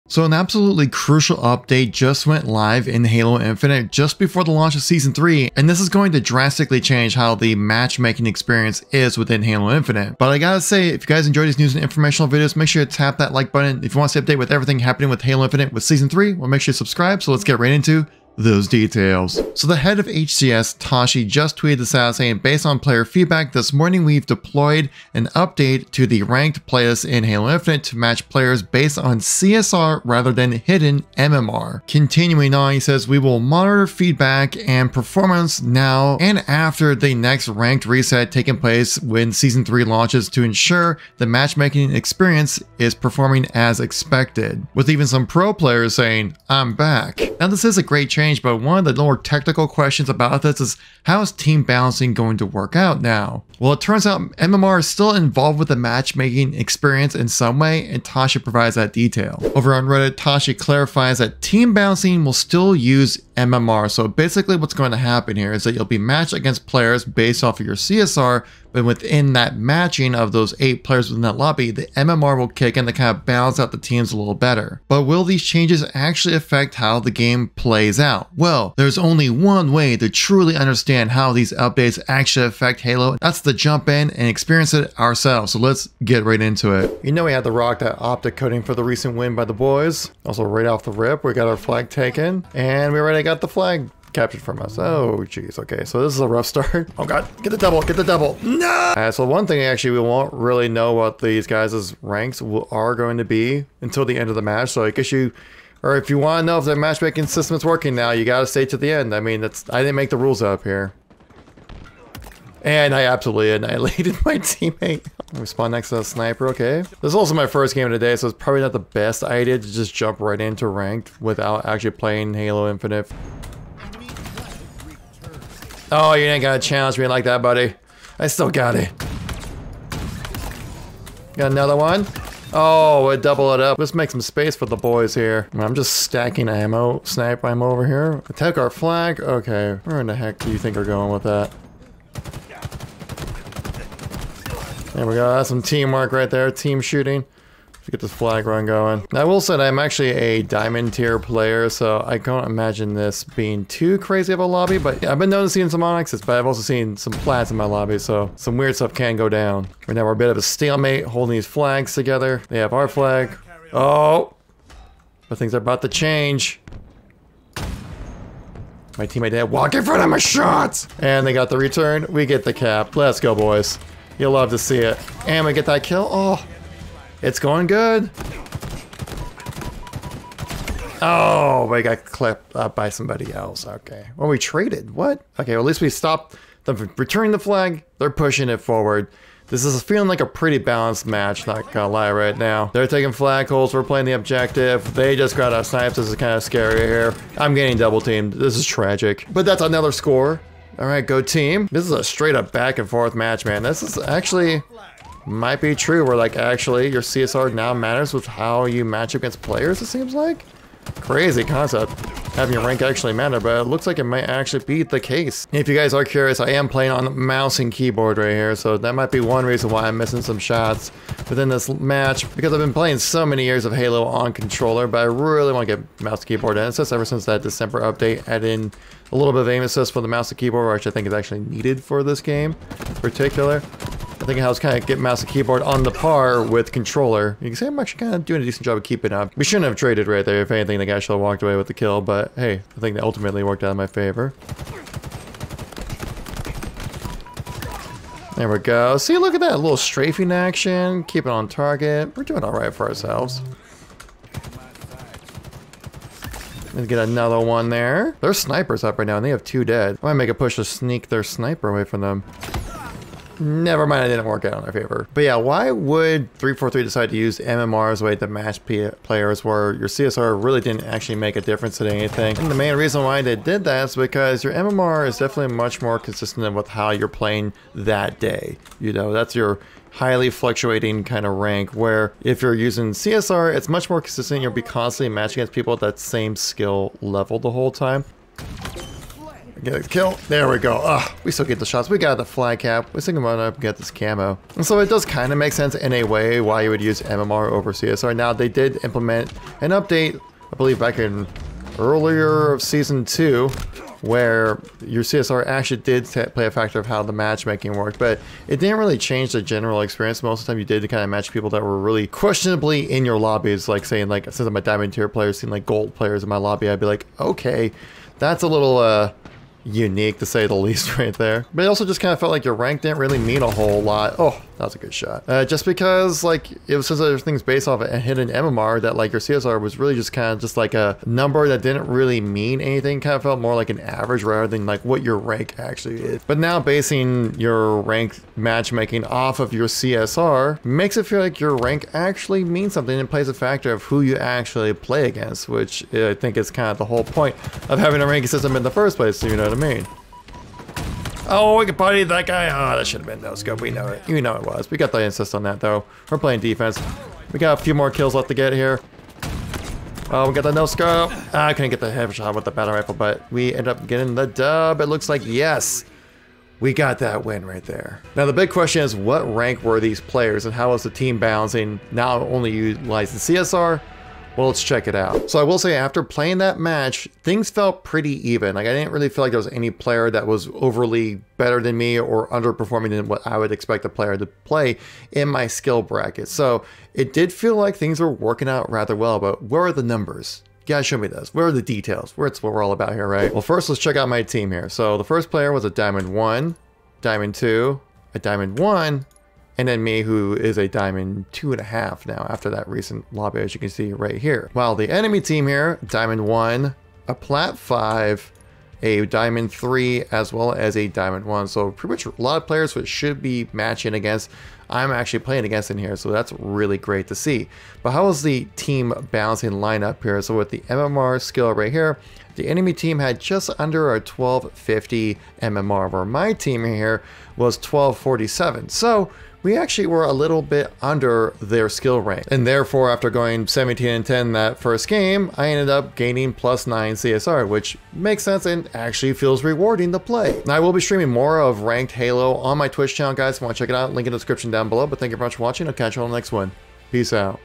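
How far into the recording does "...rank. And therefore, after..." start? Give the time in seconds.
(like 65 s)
431 s.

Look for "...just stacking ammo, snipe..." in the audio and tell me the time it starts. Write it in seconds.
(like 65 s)
135 s.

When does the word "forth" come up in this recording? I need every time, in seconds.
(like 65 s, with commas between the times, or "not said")
202 s.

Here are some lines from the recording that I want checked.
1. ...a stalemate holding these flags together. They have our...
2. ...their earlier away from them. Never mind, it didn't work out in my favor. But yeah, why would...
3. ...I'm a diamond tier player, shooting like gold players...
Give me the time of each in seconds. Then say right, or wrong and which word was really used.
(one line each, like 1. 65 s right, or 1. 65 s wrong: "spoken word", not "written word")
1. 160 s right
2. 261 s wrong: "sniper", not "earlier"
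3. 314 s wrong: "seeing", not "shooting".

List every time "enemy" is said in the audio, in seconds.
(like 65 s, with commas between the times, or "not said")
404 s, 422 s.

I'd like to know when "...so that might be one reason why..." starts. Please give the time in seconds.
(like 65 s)
218 s.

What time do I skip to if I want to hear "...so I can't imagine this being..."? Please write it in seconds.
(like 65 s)
151 s.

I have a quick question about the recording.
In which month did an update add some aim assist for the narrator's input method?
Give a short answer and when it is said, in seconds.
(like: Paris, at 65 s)
December, at 227 s.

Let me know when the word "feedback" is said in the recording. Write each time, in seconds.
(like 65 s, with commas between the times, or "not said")
23 s, 33 s.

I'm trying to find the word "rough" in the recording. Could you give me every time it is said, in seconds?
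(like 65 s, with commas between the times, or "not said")
96 s.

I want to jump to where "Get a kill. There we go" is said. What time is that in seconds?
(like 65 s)
289 s.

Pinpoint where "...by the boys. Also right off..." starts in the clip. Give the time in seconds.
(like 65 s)
89 s.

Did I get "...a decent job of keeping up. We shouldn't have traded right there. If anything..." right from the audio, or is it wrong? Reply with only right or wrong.
right.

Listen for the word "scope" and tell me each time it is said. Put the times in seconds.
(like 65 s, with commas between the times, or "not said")
353 s, 360 s.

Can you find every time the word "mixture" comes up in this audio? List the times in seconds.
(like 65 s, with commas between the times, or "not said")
not said.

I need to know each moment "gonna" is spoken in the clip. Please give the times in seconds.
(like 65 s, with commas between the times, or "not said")
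126 s, 191 s.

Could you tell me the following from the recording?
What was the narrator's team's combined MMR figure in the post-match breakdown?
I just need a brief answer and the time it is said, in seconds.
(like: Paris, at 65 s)
1247, at 427 s.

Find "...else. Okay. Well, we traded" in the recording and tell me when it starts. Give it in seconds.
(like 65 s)
183 s.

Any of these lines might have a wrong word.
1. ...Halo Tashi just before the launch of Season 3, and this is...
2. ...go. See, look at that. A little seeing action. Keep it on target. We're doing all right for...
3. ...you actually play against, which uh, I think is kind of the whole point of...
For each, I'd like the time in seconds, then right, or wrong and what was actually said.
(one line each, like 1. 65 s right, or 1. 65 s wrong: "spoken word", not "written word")
1. 3 s wrong: "Infinite", not "Tashi"
2. 248 s wrong: "strafing", not "seeing"
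3. 344 s right.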